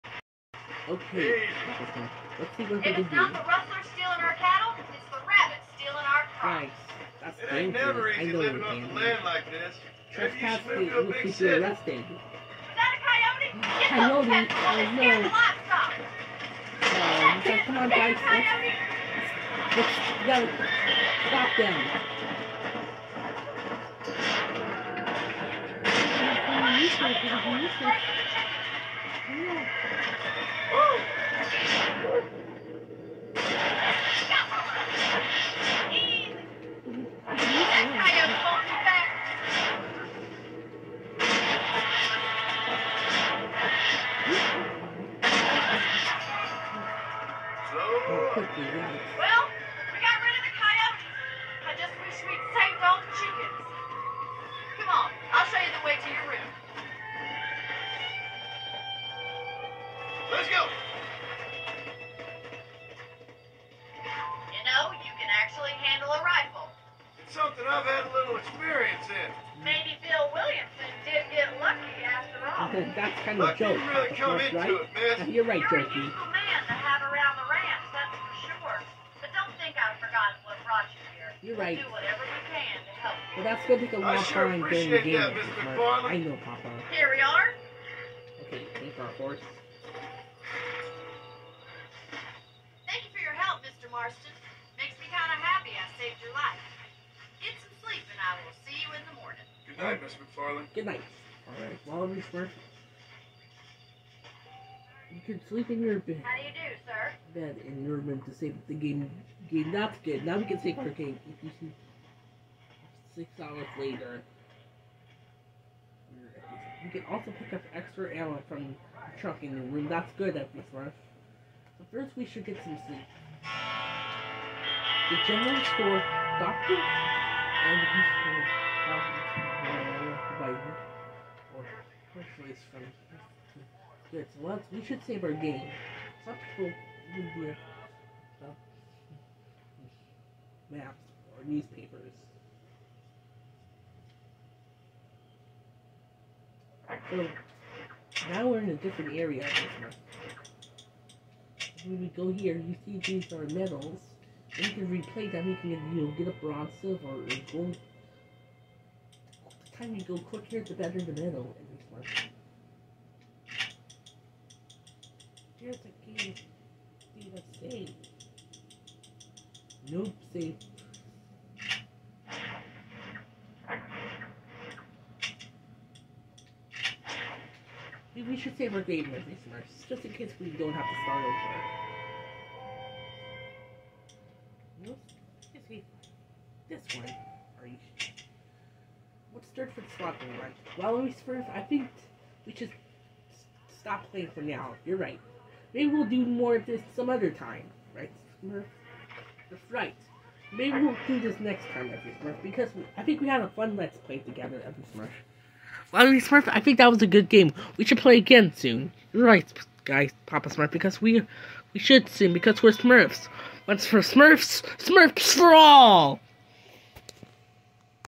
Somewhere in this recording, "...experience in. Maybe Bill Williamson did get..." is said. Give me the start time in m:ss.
1:08.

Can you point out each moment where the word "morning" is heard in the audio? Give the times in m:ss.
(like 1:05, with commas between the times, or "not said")
1:39.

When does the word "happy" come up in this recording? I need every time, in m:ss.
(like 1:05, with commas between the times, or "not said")
1:35.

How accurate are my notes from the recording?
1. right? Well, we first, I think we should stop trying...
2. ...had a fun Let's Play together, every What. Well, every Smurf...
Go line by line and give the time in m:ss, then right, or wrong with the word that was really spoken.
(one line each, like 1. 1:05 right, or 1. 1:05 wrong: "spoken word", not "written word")
1. 3:10 wrong: "playing", not "trying"
2. 3:23 wrong: "Smurf", not "What".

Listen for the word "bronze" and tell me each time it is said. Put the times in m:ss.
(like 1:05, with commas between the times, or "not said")
2:36.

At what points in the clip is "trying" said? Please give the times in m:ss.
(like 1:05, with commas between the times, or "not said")
1:24.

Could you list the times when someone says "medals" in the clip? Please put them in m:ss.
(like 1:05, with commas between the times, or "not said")
2:33, 2:41.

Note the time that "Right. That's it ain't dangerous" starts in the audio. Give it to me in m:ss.
0:06.